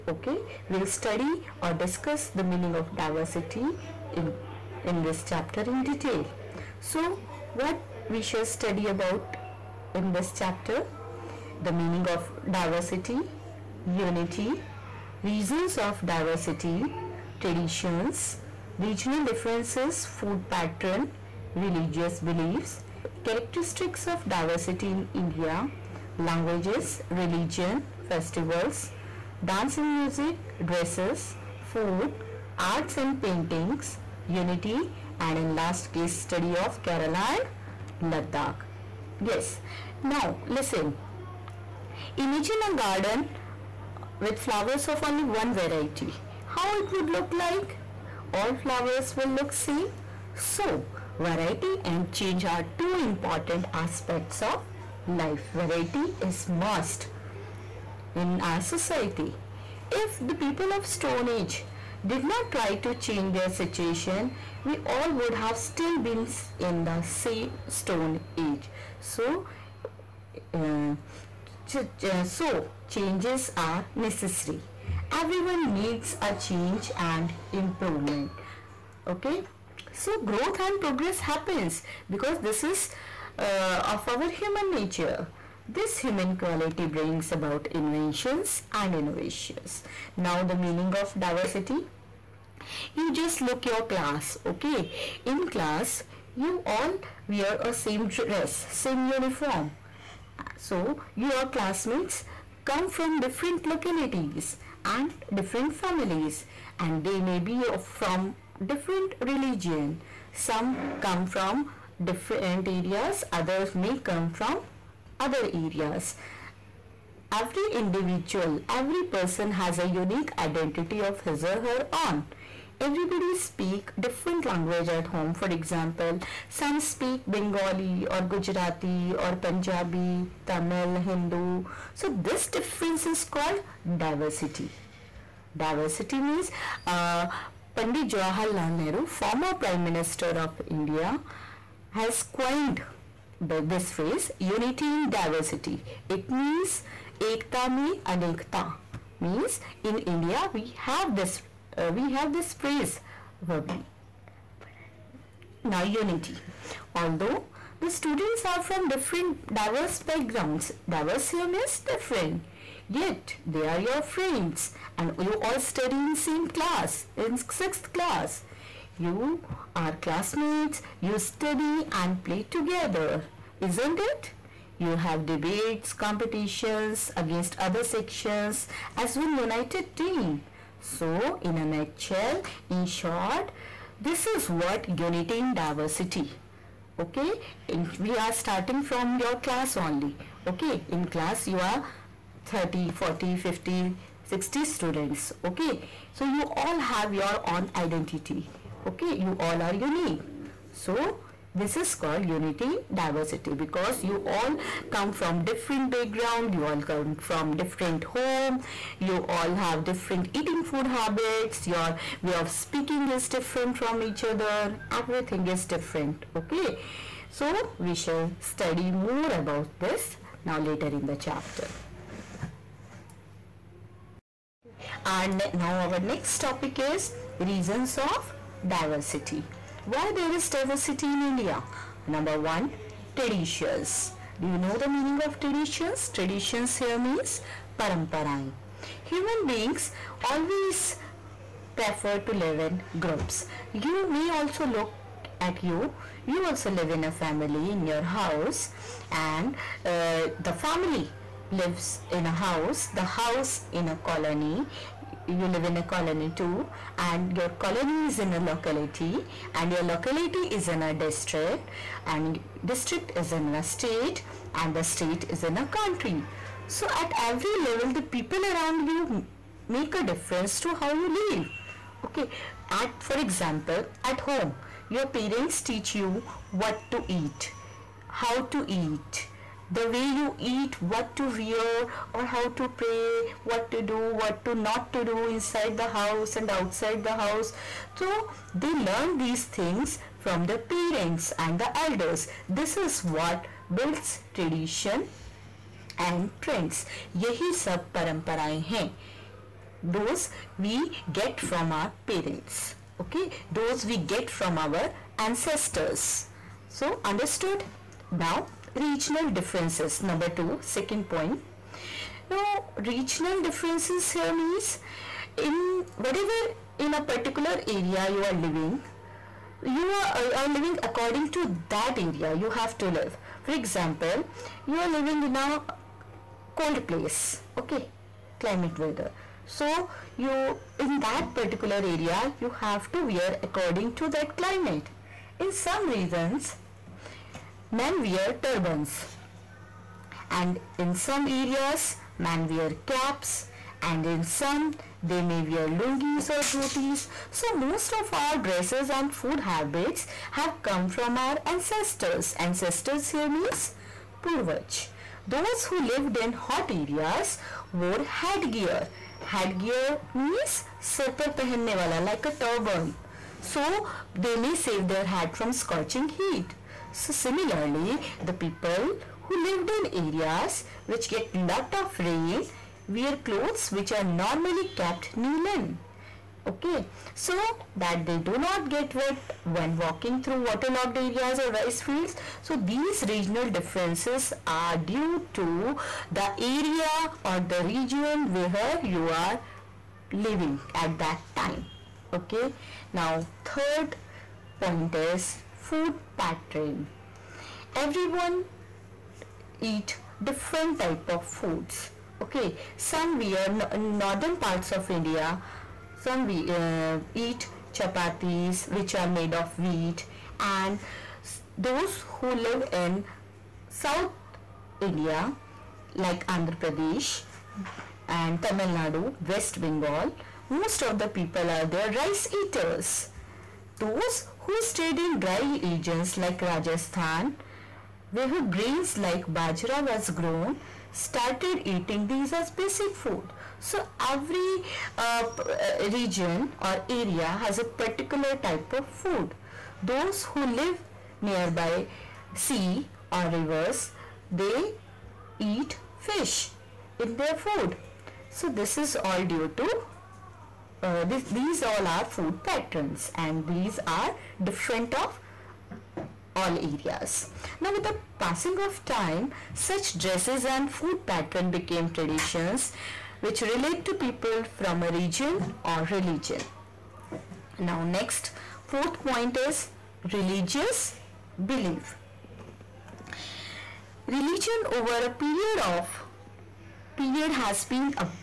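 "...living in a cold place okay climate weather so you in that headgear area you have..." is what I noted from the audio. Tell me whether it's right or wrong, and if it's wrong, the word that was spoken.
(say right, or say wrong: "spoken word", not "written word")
wrong: "particular", not "headgear".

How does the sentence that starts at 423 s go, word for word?
Those who stayed in dry regions like Rajasthan, where grains like bajra was grown, started eating these as basic food.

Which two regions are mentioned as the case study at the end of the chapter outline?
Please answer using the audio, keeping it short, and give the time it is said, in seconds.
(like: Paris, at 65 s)
Kerala and Ladakh, at 36 s.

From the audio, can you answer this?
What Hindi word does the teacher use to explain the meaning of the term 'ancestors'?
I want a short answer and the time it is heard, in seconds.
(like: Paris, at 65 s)
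Purvaj, at 354 s.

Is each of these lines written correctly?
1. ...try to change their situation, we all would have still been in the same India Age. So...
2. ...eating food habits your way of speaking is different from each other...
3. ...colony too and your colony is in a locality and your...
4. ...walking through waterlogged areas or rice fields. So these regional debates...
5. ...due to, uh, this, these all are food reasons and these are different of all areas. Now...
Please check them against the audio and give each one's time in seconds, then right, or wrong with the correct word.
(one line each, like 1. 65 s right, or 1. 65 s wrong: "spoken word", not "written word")
1. 62 s wrong: "Stone", not "India"
2. 210 s right
3. 255 s right
4. 379 s wrong: "differences", not "debates"
5. 449 s wrong: "patterns", not "reasons".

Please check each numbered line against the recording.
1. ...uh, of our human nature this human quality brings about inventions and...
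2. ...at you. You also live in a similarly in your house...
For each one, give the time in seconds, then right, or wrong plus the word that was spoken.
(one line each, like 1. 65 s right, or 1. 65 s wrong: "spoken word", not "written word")
1. 83 s right
2. 245 s wrong: "family", not "similarly".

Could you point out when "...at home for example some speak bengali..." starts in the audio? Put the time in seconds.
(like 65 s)
124 s.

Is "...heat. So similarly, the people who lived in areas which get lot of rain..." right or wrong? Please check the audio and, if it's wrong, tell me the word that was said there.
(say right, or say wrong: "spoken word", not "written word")
right.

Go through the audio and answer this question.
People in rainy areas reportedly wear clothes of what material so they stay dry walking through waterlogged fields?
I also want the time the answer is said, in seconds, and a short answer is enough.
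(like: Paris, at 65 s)
Nylon, at 375 s.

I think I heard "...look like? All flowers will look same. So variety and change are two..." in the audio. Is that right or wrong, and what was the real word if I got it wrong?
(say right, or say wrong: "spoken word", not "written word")
right.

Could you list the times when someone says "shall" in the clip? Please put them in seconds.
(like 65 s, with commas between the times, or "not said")
8 s, 217 s.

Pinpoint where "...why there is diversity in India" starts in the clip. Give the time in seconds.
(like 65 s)
229 s.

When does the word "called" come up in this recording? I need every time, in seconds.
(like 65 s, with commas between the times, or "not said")
133 s, 201 s.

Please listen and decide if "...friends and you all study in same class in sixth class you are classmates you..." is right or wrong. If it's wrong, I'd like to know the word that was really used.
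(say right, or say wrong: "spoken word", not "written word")
right.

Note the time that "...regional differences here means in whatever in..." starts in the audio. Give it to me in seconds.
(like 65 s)
312 s.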